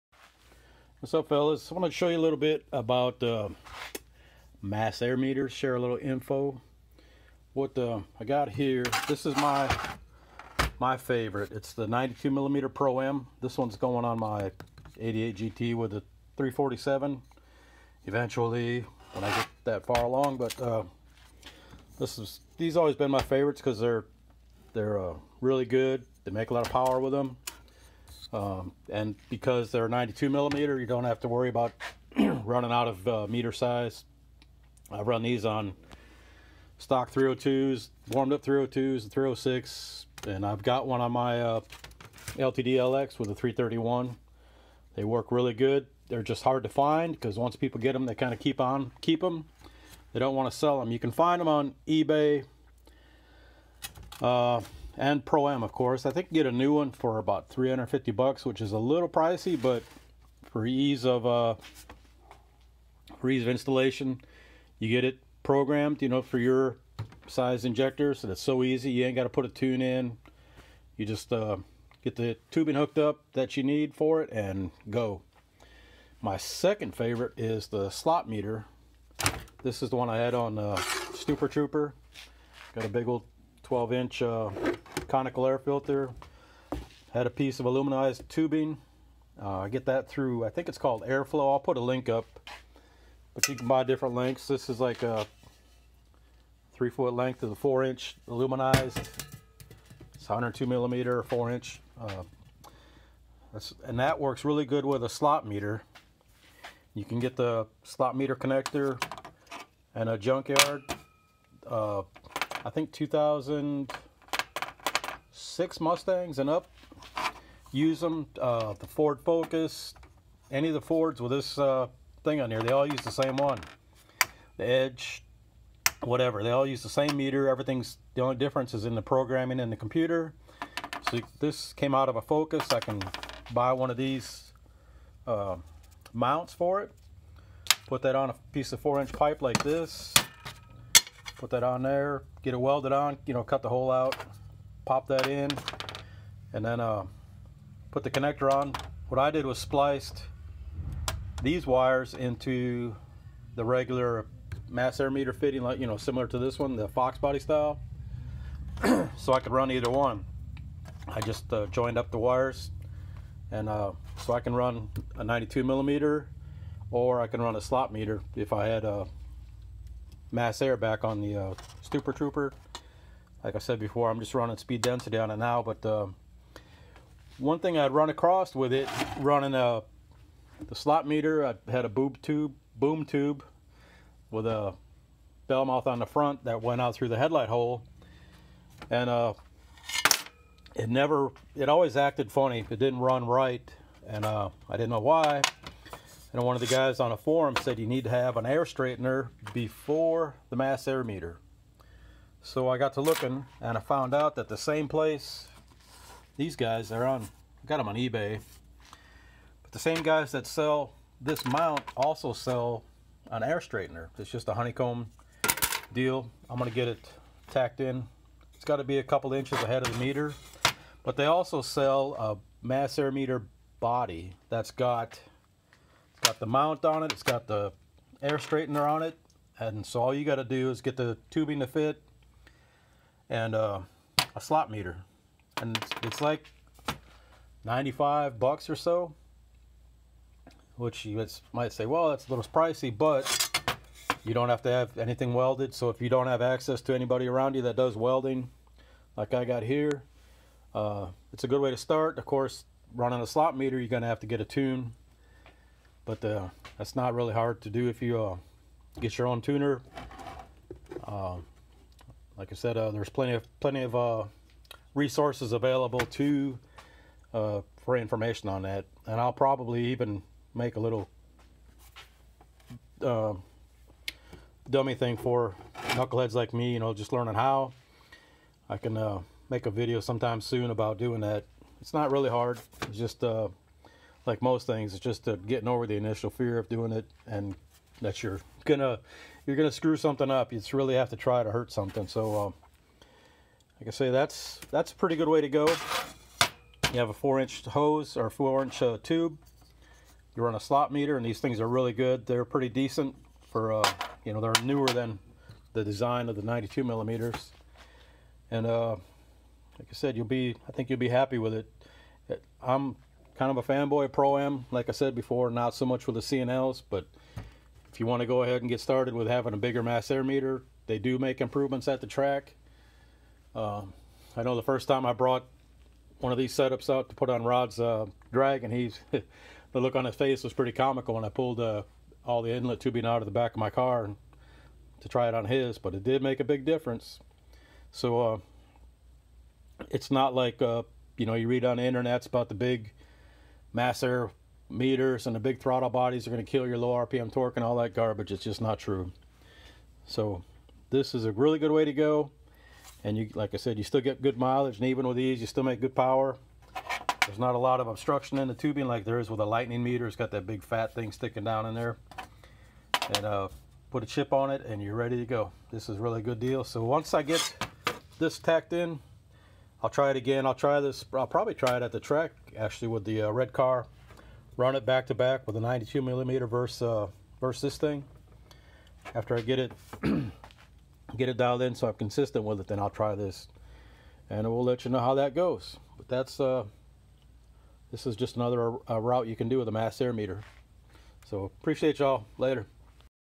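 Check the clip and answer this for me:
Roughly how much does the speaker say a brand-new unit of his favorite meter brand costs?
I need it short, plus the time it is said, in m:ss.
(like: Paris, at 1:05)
$350, at 0:57.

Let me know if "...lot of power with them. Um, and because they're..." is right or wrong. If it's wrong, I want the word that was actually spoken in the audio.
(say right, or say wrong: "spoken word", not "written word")
right.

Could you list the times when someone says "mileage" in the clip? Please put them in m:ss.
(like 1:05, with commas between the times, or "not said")
5:54.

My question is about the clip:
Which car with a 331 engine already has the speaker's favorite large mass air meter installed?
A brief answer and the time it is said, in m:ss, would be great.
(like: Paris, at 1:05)
LTD LX, at 0:42.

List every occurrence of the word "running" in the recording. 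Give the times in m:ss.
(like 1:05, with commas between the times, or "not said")
0:32, 2:54, 2:59, 4:12.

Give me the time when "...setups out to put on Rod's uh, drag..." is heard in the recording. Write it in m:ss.
5:26.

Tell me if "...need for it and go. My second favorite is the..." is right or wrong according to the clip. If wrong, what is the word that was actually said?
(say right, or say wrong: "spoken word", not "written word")
right.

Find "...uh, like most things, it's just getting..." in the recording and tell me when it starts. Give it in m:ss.
4:43.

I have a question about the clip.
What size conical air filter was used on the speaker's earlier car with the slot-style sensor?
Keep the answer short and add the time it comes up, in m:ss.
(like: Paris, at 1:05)
12 inch, at 1:23.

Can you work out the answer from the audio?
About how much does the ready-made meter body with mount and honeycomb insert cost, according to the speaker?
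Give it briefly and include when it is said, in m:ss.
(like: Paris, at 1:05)
$95, at 3:57.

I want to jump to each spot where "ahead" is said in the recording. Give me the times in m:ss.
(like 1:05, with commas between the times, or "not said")
3:39, 5:18.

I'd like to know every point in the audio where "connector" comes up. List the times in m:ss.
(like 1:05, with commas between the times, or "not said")
1:48, 2:28.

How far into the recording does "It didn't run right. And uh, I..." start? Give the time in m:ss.
3:12.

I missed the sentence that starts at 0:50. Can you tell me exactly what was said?
They don't want to sell them.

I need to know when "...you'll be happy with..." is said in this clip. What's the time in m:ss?
5:10.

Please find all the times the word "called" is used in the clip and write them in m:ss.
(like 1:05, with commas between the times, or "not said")
1:30.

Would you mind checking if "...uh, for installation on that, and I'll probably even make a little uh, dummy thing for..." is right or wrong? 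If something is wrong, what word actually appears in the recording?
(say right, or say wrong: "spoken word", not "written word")
wrong: "information", not "installation".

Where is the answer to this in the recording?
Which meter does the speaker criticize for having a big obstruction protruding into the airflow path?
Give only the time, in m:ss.
5:59.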